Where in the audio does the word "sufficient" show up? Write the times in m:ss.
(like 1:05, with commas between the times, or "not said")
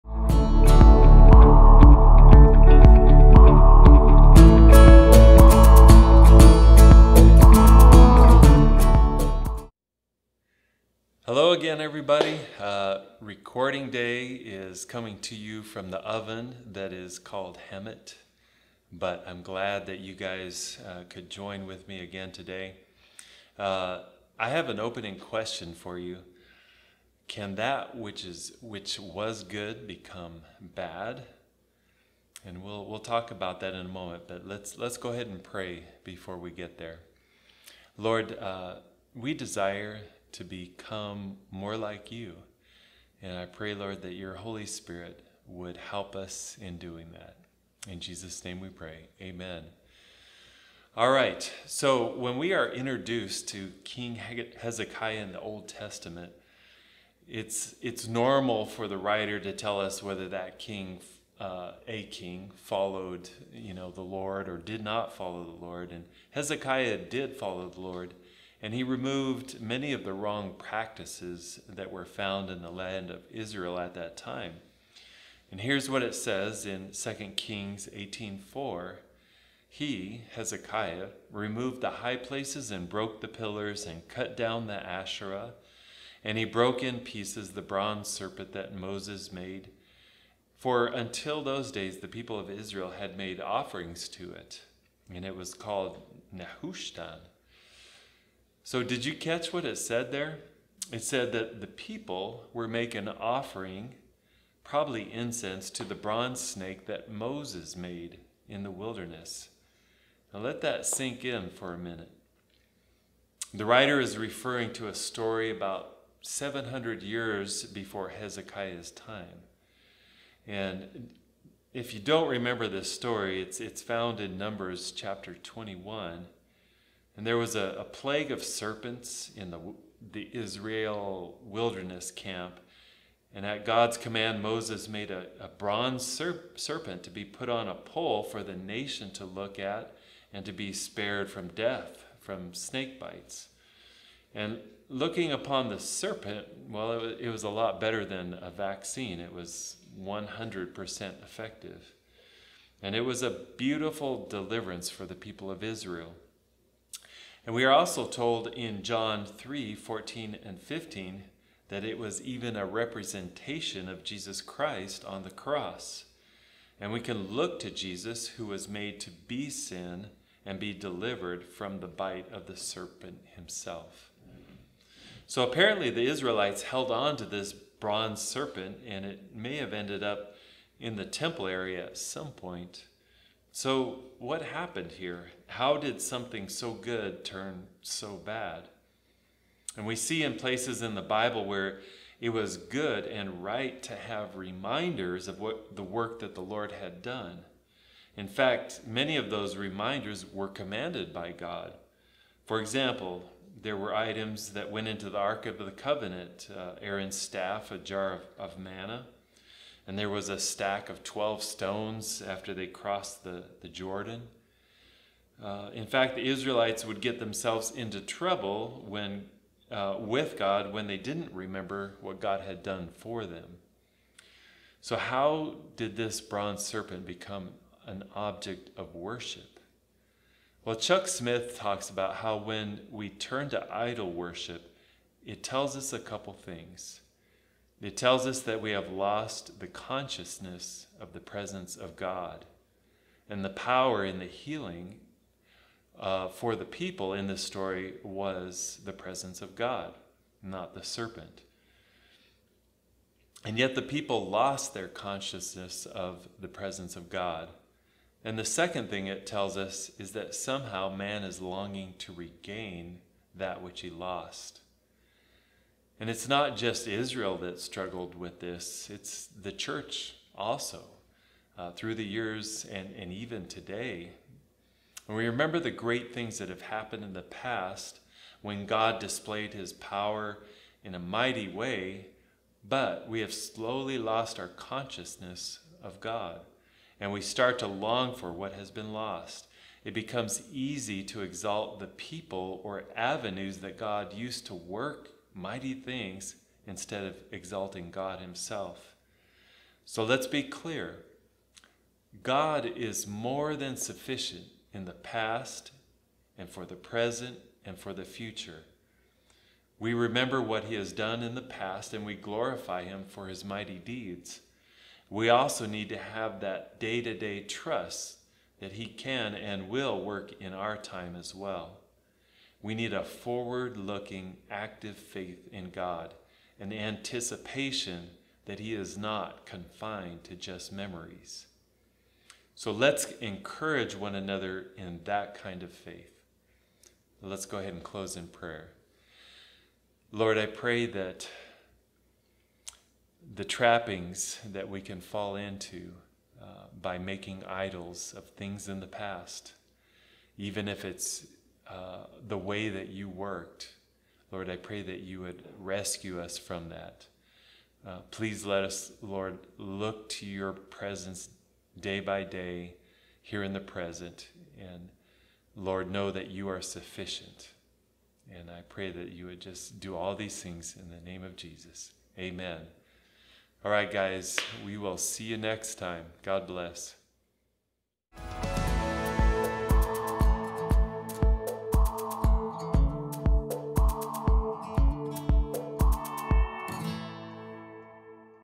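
5:03, 6:06.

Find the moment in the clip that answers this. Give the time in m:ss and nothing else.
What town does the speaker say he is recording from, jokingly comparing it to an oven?
0:17.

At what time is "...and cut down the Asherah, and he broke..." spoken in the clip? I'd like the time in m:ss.
1:23.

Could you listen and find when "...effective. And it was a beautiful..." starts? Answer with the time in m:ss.
2:31.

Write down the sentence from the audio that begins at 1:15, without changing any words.
And here's what it says in 2 Kings 18:4.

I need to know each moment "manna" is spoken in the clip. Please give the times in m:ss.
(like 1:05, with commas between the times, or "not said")
3:28.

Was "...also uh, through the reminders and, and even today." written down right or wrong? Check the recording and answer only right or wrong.
wrong.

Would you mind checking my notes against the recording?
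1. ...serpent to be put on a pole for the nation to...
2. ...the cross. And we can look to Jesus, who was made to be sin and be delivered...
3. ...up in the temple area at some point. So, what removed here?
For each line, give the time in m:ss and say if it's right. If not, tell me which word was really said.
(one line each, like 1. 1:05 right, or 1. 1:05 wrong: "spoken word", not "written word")
1. 2:16 right
2. 2:45 right
3. 3:00 wrong: "happened", not "removed".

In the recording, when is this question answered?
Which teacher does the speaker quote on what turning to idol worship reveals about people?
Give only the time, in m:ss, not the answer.
3:50.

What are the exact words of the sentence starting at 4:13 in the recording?
And yet the people lost their consciousness of the presence of God.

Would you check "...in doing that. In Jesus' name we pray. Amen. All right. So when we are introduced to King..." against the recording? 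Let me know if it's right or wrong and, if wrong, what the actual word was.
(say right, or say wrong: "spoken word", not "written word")
right.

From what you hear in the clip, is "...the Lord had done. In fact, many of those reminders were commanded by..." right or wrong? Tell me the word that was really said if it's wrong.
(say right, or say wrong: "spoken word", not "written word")
right.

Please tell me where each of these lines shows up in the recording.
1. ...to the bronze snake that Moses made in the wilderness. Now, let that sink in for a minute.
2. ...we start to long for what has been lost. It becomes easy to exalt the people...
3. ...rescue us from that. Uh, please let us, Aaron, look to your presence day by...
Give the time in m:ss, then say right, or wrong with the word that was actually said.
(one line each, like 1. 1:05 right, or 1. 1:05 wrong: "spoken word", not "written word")
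1. 1:45 right
2. 4:47 right
3. 5:55 wrong: "Lord", not "Aaron".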